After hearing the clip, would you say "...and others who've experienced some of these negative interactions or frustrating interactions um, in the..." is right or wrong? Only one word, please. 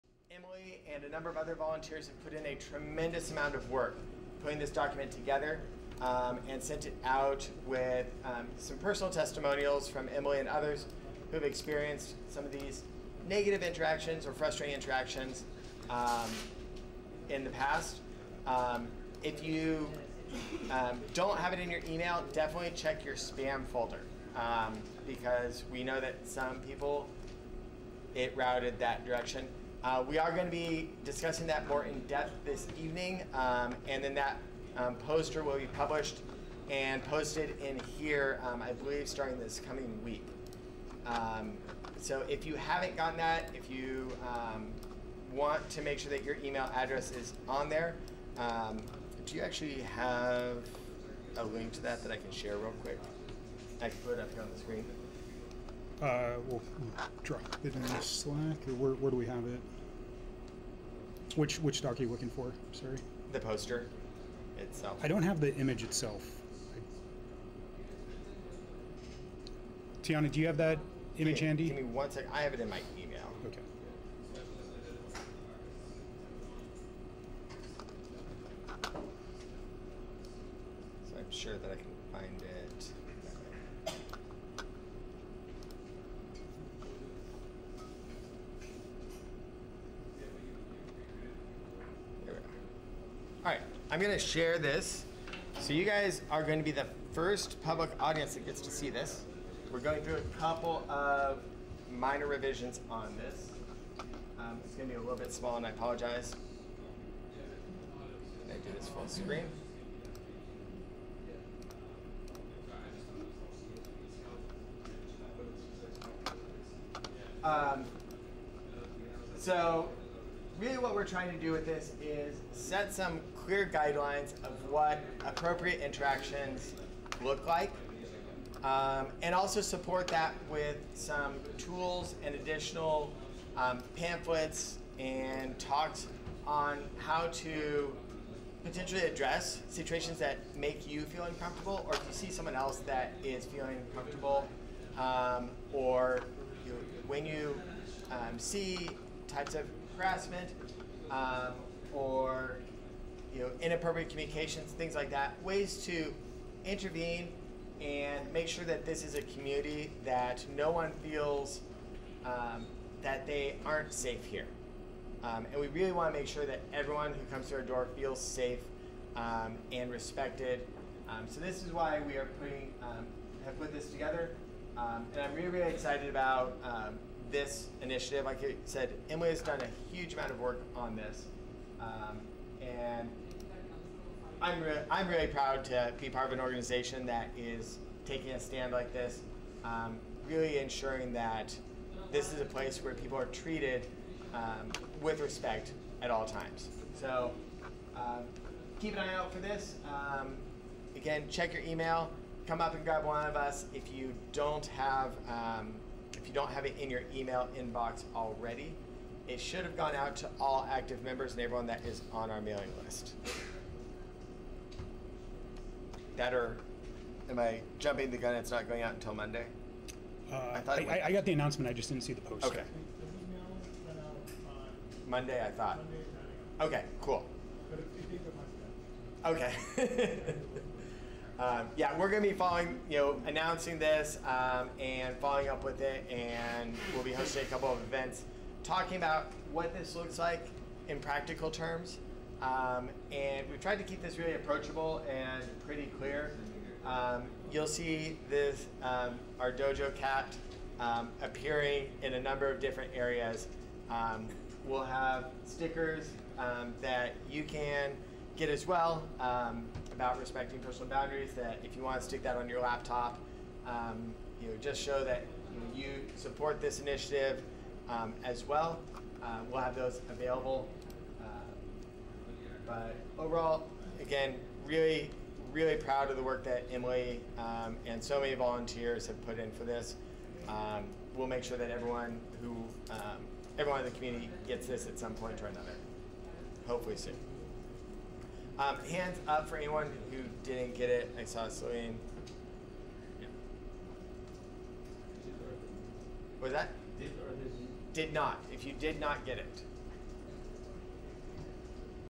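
right.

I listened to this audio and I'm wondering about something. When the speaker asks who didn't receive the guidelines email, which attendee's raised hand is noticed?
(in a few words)
Celine.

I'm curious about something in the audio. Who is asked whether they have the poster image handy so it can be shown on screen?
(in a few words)
Tiana.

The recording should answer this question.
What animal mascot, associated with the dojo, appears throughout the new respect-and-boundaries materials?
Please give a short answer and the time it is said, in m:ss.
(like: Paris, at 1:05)
cat, at 4:09.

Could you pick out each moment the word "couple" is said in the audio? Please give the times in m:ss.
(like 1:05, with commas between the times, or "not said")
1:40, 3:57.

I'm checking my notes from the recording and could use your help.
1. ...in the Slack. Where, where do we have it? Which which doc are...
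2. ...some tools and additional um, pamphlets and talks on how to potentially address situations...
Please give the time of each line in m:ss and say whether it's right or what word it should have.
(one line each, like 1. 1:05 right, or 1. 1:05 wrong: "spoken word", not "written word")
1. 0:57 right
2. 2:10 right.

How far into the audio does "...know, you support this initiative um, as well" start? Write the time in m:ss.
4:25.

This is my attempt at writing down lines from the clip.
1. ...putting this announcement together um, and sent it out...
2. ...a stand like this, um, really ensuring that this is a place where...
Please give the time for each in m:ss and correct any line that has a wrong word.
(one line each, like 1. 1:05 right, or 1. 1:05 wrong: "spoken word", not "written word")
1. 0:04 wrong: "document", not "announcement"
2. 3:08 right.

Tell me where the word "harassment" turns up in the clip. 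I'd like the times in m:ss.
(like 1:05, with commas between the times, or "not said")
2:30.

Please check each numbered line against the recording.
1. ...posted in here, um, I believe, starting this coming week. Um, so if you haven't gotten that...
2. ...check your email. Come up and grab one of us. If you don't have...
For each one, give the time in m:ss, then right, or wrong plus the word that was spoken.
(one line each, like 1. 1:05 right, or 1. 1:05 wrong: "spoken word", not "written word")
1. 0:37 right
2. 3:21 right.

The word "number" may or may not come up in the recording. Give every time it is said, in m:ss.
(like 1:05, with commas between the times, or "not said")
0:01, 4:12.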